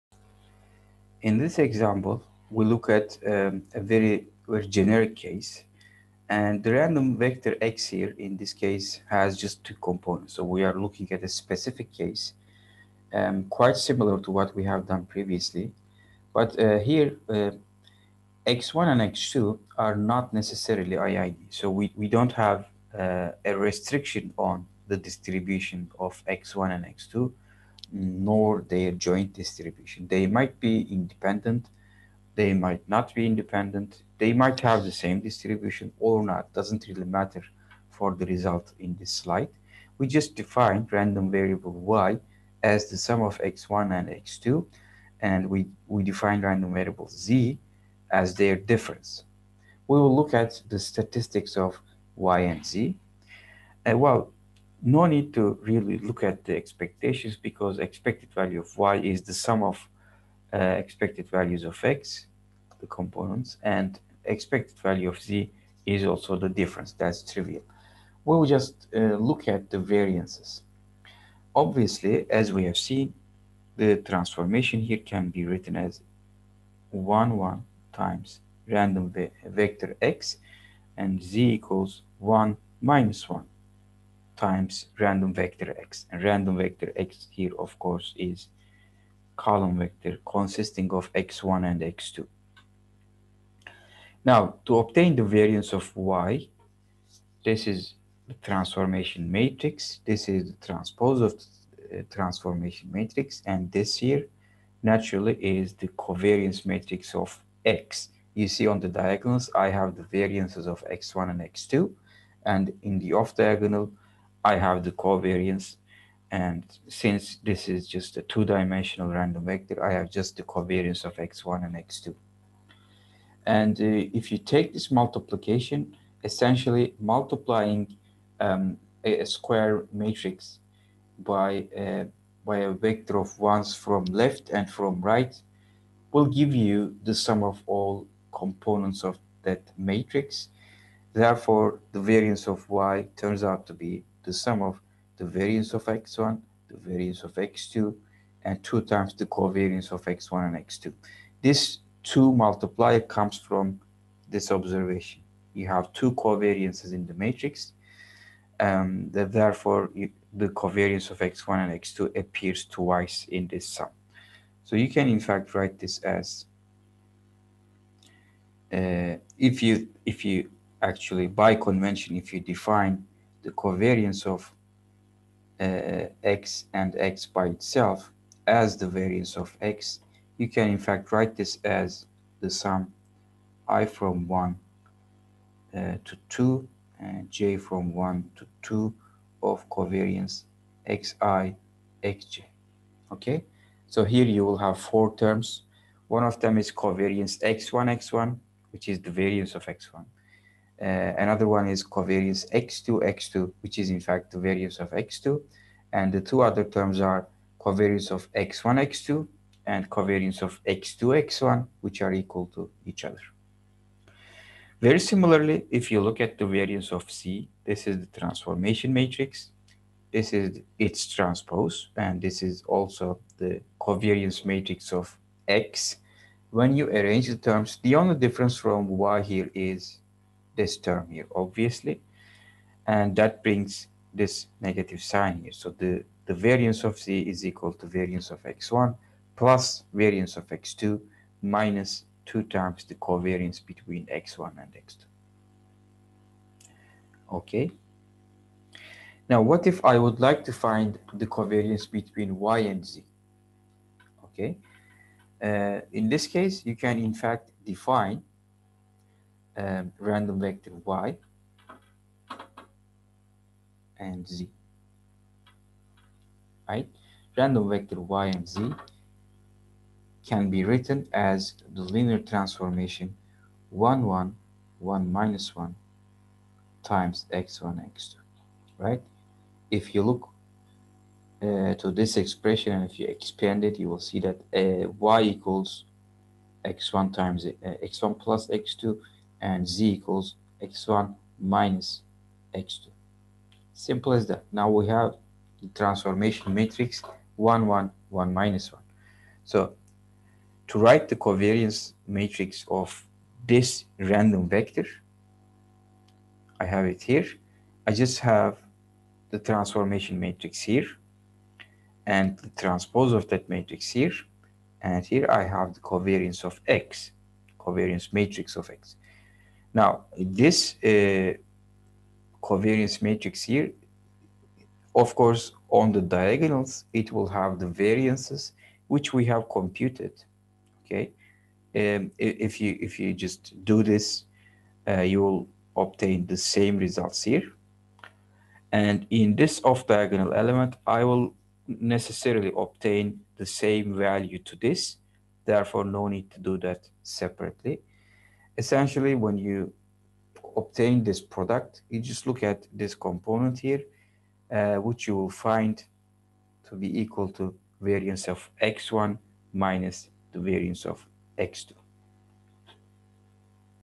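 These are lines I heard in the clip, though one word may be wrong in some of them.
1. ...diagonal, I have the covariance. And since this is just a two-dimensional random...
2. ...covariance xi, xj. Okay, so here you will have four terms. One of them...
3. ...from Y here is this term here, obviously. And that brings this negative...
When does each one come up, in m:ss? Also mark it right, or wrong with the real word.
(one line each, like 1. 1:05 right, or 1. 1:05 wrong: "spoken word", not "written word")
1. 1:53 right
2. 3:09 right
3. 3:48 right.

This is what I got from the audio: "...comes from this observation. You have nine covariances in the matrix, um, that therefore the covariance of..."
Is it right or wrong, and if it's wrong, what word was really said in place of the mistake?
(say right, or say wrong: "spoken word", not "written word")
wrong: "two", not "nine".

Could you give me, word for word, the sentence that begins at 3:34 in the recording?
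Very similarly, if you look at the variance of z, this is the transformation matrix.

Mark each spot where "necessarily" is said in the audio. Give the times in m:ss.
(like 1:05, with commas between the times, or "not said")
0:20, 5:41.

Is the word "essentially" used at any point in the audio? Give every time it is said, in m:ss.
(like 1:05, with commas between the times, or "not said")
2:06, 5:48.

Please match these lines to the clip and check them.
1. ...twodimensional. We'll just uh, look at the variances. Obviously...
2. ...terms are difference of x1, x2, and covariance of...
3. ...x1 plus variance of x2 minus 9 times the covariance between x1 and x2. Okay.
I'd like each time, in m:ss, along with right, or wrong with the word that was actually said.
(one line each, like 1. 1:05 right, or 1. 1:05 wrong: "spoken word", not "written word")
1. 1:07 wrong: "trivial", not "twodimensional"
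2. 3:26 wrong: "covariance", not "difference"
3. 3:58 wrong: "2", not "9".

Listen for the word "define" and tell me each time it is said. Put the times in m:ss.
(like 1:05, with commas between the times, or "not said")
0:40, 0:46, 2:52, 4:17.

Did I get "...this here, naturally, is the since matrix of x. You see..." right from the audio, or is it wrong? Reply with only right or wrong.
wrong.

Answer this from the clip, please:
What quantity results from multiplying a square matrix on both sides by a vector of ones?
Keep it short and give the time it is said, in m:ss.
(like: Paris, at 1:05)
sum of all components, at 2:17.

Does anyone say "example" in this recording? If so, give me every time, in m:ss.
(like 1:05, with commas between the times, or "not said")
0:01.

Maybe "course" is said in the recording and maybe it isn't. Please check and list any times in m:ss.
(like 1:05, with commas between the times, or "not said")
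1:27, 5:25.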